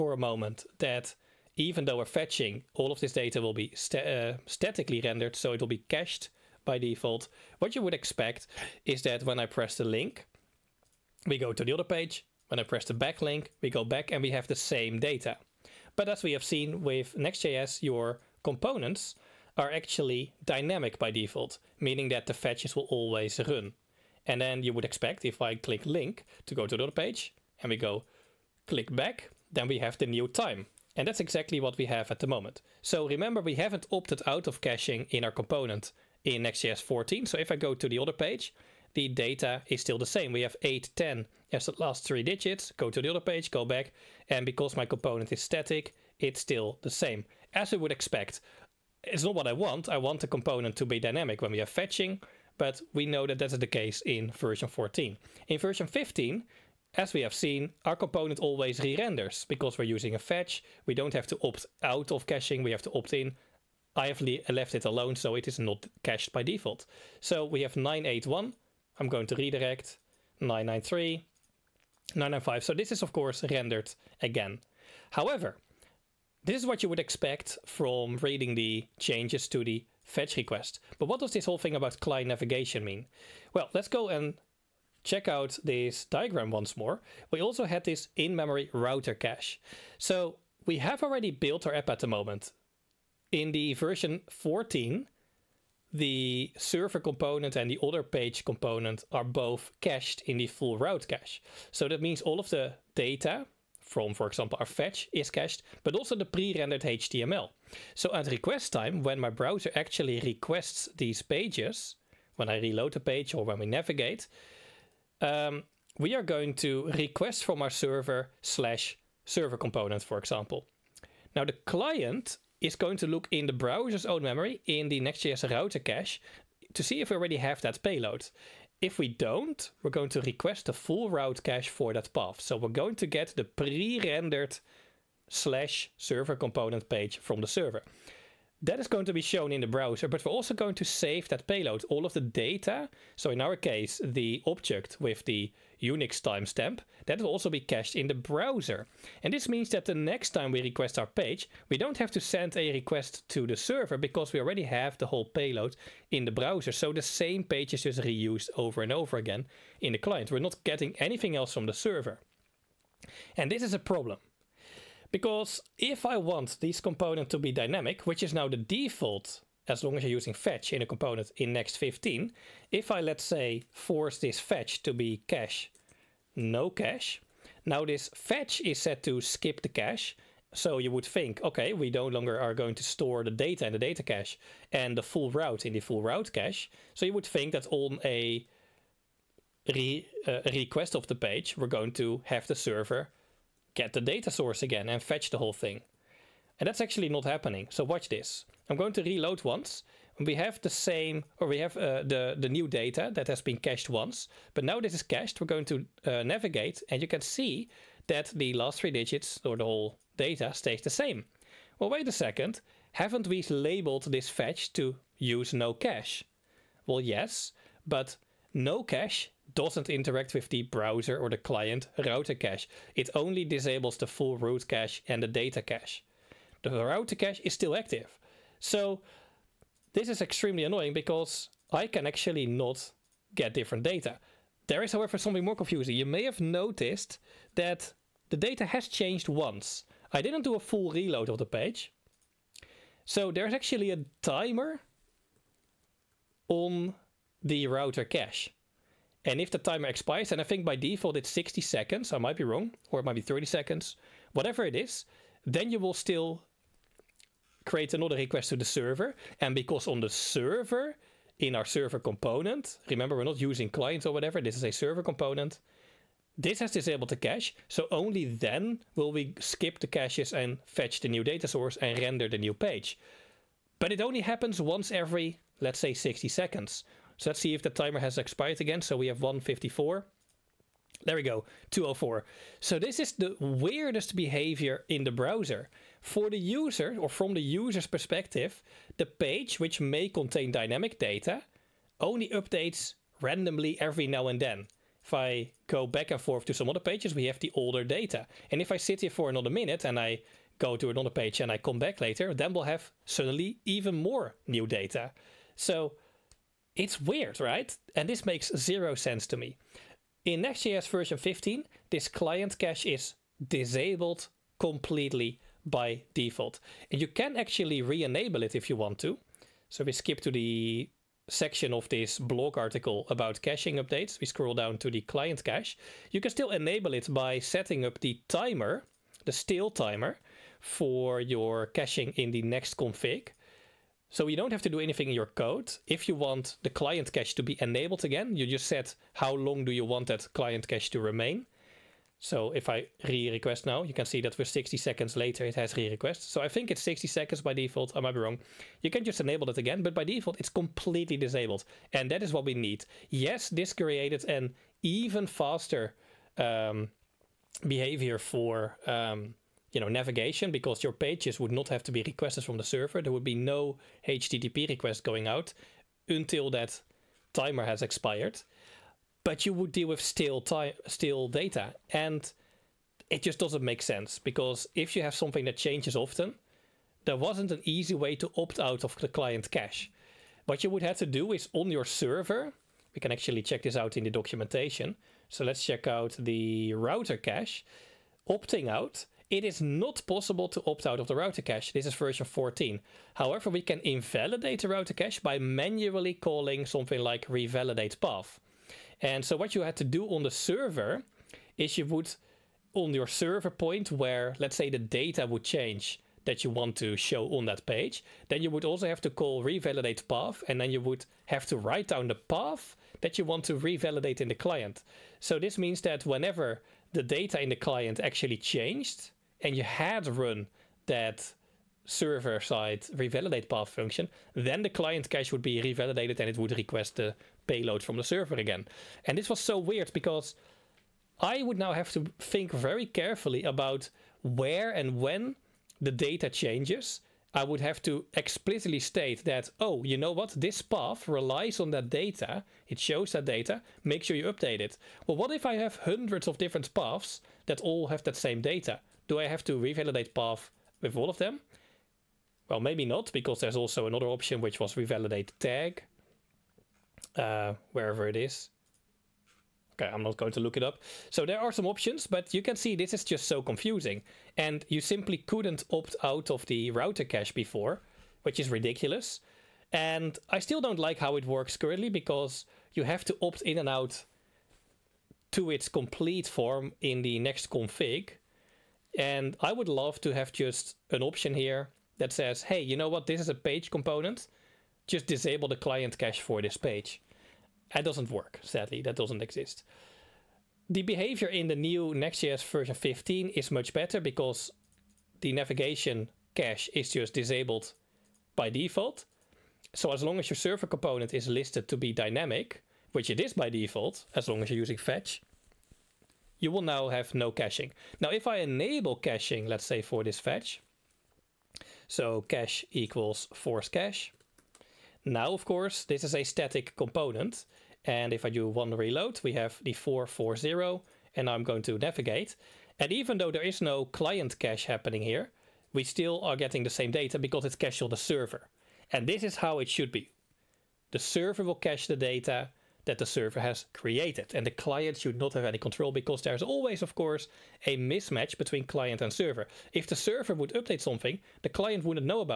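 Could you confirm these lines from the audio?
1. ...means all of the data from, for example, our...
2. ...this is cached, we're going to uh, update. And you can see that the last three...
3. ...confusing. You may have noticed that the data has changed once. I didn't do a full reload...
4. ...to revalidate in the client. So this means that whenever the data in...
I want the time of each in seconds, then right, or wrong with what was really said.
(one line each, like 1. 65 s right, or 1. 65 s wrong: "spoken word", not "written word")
1. 102 s right
2. 204 s wrong: "navigate", not "update"
3. 235 s right
4. 413 s right.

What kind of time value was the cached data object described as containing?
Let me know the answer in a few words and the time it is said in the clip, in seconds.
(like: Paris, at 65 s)
Unix timestamp, at 145 s.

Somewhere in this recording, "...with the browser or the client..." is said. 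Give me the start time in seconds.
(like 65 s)
220 s.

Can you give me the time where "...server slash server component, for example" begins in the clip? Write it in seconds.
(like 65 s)
117 s.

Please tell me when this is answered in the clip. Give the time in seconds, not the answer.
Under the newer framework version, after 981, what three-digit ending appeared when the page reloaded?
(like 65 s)
70 s.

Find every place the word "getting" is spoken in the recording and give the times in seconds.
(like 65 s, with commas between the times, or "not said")
160 s, 526 s.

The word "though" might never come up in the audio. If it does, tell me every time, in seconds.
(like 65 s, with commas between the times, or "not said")
1 s, 523 s.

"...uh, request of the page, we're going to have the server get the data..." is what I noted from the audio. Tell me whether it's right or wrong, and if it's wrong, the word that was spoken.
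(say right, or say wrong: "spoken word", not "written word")
right.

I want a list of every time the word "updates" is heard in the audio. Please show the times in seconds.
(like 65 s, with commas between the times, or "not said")
292 s, 323 s, 444 s, 540 s.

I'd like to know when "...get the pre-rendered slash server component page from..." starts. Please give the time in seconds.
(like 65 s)
133 s.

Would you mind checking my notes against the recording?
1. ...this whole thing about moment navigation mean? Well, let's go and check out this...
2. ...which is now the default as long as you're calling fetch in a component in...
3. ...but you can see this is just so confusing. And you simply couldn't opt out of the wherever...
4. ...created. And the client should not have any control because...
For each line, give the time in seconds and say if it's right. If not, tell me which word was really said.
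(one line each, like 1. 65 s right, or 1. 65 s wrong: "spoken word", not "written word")
1. 81 s wrong: "client", not "moment"
2. 168 s wrong: "using", not "calling"
3. 462 s wrong: "router", not "wherever"
4. 533 s right.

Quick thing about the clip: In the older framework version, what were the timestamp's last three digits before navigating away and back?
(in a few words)
810.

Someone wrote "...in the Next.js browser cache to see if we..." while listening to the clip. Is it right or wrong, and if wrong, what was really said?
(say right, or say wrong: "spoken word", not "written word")
wrong: "router", not "browser".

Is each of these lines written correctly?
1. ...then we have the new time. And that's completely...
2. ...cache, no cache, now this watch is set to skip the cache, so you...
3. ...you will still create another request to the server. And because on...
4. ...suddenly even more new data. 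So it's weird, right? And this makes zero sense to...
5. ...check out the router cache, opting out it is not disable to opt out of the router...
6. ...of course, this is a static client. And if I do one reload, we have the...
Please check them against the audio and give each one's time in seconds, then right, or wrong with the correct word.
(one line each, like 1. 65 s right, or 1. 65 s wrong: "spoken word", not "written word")
1. 29 s wrong: "exactly", not "completely"
2. 175 s wrong: "fetch", not "watch"
3. 255 s right
4. 303 s right
5. 385 s wrong: "possible", not "disable"
6. 515 s wrong: "component", not "client".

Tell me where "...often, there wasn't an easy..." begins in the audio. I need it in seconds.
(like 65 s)
375 s.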